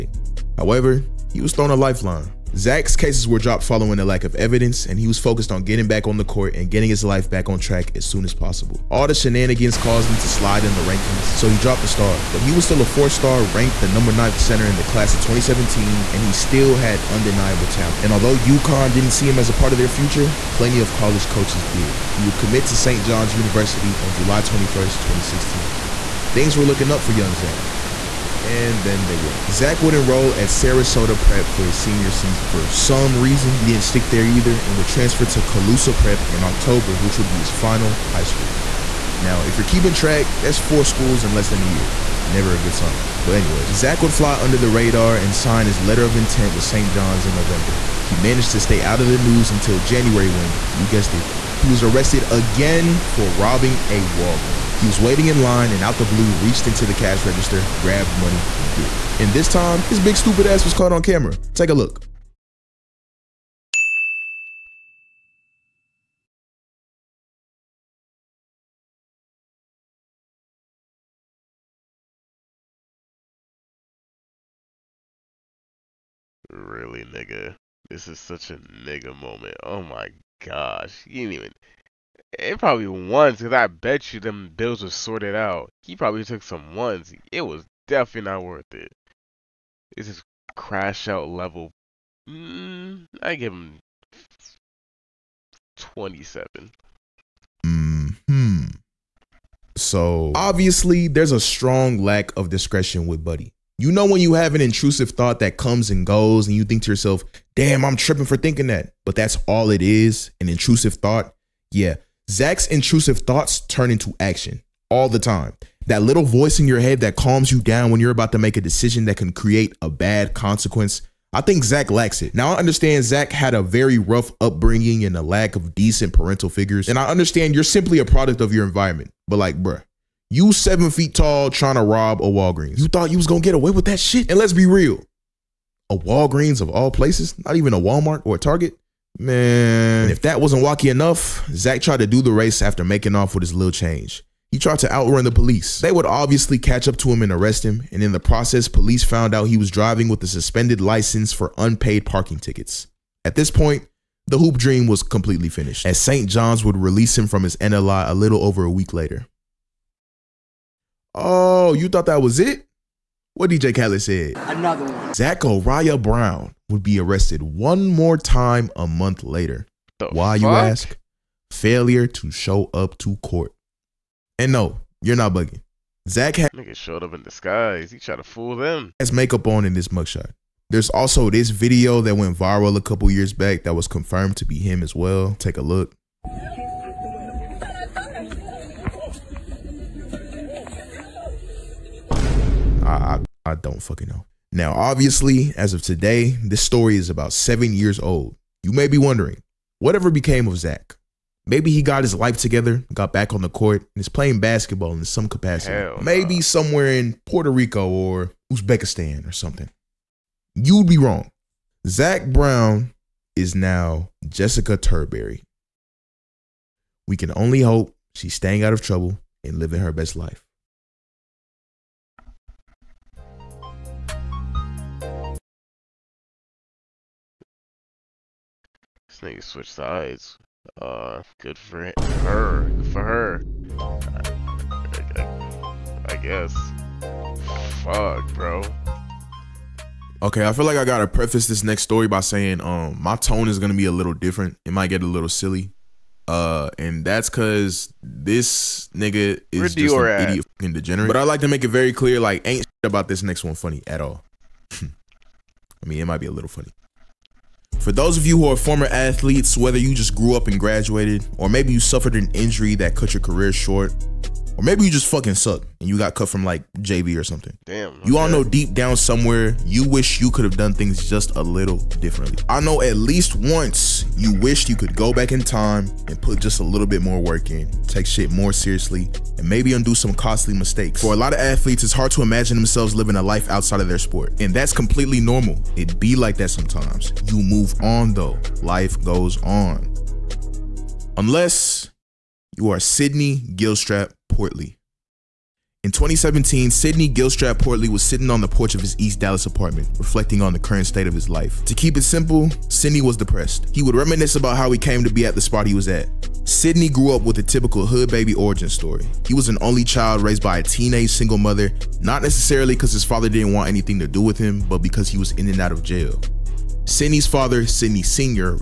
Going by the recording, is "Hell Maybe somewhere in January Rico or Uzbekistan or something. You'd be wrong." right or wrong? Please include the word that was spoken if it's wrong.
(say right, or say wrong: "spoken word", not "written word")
wrong: "Puerto", not "January".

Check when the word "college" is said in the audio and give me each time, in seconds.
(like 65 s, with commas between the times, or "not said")
20 s.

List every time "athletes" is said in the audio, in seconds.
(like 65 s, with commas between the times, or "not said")
258 s, 281 s.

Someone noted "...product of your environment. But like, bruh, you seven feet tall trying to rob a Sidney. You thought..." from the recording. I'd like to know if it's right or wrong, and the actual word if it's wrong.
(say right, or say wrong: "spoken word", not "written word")
wrong: "Walgreens", not "Sidney".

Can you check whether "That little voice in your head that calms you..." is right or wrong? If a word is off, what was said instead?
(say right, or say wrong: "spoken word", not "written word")
right.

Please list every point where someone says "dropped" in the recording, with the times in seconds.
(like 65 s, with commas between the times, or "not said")
3 s, 11 s.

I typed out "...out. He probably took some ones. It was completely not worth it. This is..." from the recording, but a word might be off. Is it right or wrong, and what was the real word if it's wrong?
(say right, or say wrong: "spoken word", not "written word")
wrong: "definitely", not "completely".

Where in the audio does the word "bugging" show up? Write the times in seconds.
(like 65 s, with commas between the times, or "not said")
175 s.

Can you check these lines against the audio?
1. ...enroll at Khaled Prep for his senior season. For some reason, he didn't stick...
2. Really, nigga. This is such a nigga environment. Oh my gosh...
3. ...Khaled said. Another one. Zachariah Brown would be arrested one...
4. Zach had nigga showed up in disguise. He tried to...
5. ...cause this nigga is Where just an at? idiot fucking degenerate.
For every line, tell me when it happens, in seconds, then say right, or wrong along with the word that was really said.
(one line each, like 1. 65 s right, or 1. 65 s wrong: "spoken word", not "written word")
1. 29 s wrong: "Sarasota", not "Khaled"
2. 76 s wrong: "moment", not "environment"
3. 163 s right
4. 176 s right
5. 247 s right.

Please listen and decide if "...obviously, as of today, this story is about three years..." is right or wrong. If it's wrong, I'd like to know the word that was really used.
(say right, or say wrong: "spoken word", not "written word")
wrong: "seven", not "three".